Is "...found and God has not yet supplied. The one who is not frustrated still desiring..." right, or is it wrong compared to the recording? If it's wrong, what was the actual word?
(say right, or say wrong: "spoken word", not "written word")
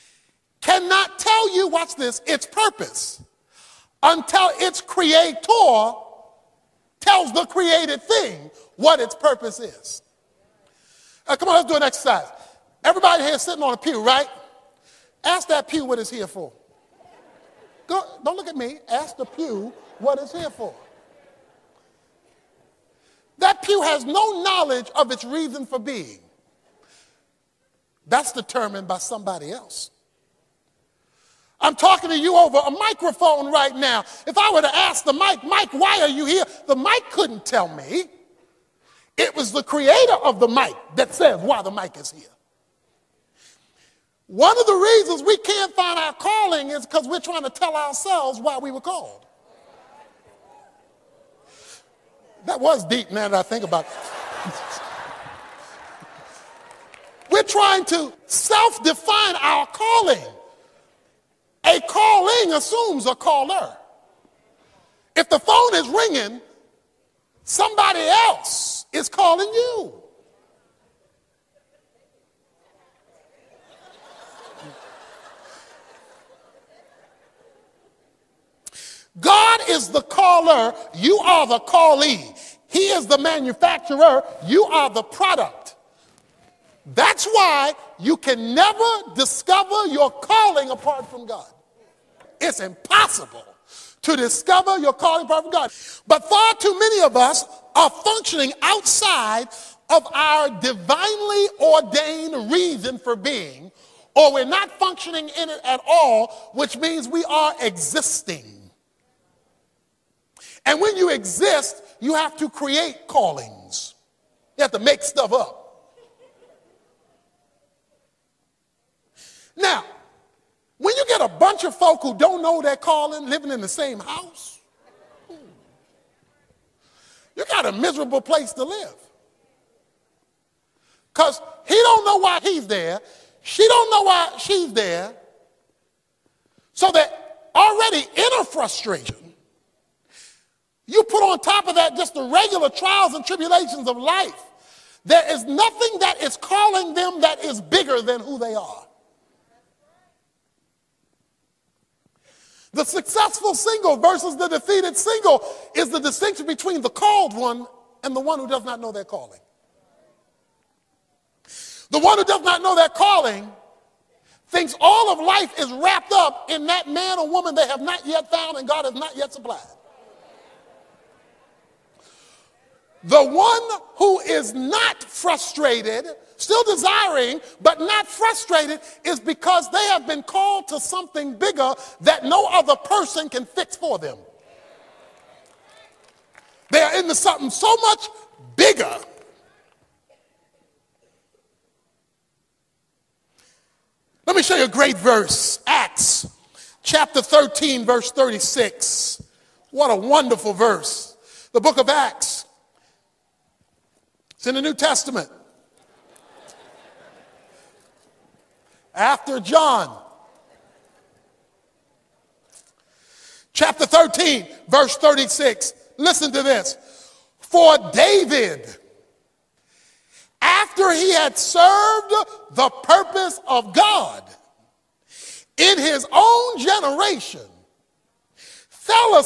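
right.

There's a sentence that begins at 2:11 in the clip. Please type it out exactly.
Because he don't know why he's there.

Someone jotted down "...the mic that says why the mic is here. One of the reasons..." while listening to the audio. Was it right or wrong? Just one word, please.
right.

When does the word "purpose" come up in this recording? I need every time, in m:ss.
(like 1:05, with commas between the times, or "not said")
0:02, 0:09, 3:42.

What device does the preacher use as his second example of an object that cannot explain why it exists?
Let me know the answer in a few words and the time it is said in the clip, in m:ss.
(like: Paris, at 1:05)
Microphone, at 0:32.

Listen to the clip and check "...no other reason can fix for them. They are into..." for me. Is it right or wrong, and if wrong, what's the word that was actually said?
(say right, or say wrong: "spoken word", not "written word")
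wrong: "person", not "reason".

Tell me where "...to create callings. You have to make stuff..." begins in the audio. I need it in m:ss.
1:52.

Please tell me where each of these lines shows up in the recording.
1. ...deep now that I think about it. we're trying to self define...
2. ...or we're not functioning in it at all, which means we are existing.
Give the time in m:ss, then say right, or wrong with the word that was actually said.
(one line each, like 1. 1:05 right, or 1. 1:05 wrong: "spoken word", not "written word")
1. 0:52 right
2. 1:44 right.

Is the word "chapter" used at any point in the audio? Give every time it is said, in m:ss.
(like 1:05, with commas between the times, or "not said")
3:16, 3:33.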